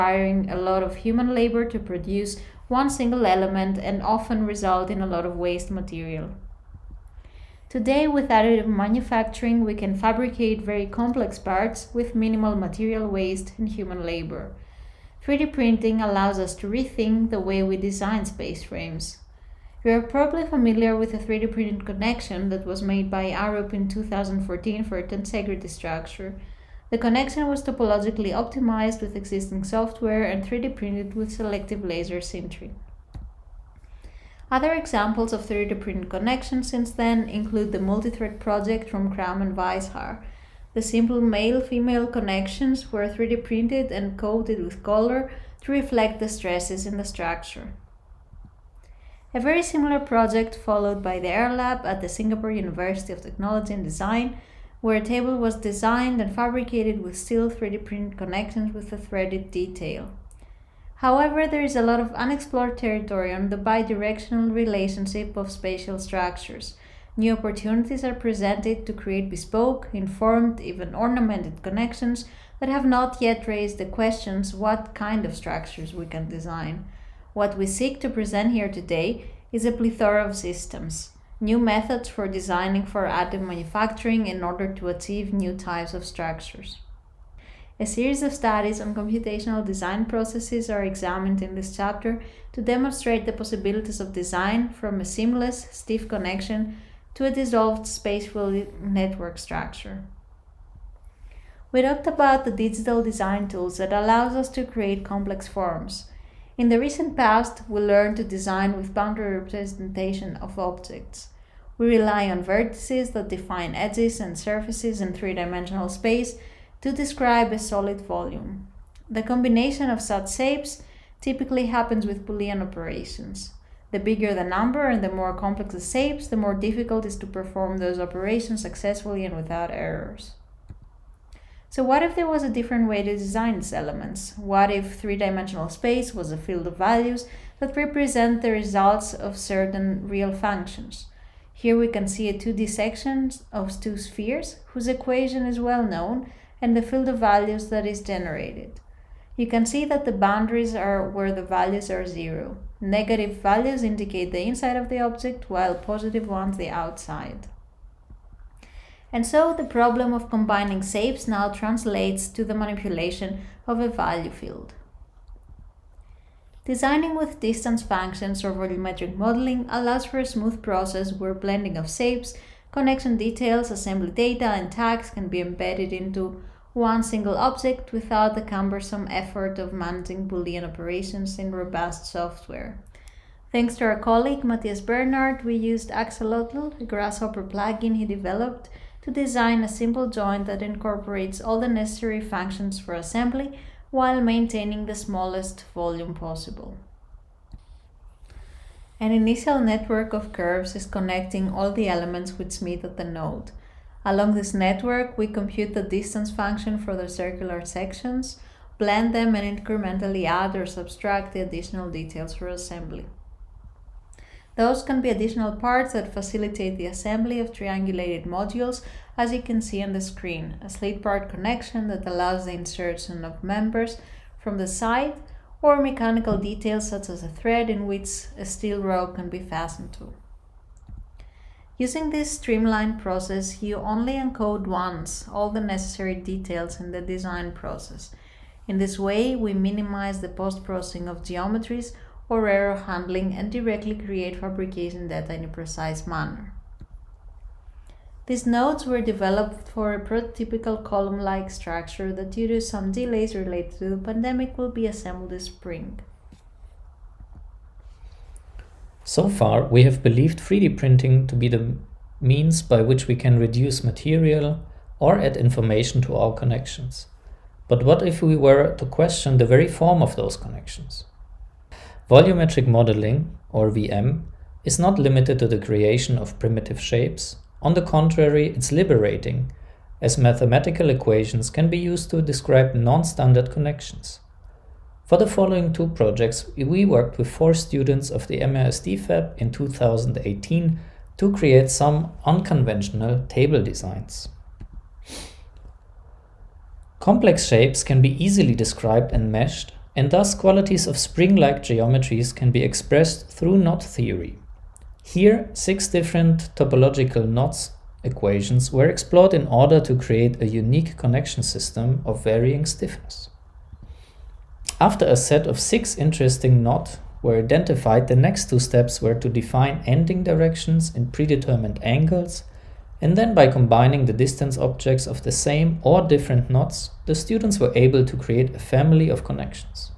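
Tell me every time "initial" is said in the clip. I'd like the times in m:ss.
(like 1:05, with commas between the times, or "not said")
3:19.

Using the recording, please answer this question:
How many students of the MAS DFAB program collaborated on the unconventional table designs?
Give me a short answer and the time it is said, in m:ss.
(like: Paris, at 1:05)
4, at 4:47.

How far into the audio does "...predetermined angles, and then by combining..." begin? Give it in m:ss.
5:21.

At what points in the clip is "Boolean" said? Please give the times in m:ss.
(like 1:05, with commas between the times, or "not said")
2:02, 3:00.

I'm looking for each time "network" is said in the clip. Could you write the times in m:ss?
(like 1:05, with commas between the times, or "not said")
1:38, 3:19, 3:24.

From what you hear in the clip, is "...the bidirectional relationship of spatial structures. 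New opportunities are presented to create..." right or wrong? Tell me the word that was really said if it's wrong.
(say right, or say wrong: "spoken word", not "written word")
right.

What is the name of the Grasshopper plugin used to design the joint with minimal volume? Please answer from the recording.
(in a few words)
Axolotl.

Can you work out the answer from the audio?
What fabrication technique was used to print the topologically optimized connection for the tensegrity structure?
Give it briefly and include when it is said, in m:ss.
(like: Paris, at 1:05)
Selective laser sintering, at 0:31.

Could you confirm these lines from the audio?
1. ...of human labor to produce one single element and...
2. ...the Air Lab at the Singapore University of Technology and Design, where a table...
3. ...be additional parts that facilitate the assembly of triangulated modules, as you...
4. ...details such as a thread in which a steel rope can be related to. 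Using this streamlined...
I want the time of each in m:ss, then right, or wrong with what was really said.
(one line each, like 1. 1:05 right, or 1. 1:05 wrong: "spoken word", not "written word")
1. 0:00 right
2. 0:51 right
3. 3:35 right
4. 3:46 wrong: "fastened", not "related".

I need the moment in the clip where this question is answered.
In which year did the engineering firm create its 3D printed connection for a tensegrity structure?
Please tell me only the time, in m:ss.
0:23.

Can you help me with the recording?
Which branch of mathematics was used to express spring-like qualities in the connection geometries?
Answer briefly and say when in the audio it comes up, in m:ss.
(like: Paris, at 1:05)
Knot theory, at 5:03.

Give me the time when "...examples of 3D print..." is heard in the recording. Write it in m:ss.
0:34.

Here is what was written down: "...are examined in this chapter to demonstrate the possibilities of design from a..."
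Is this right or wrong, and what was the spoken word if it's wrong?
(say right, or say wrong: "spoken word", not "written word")
right.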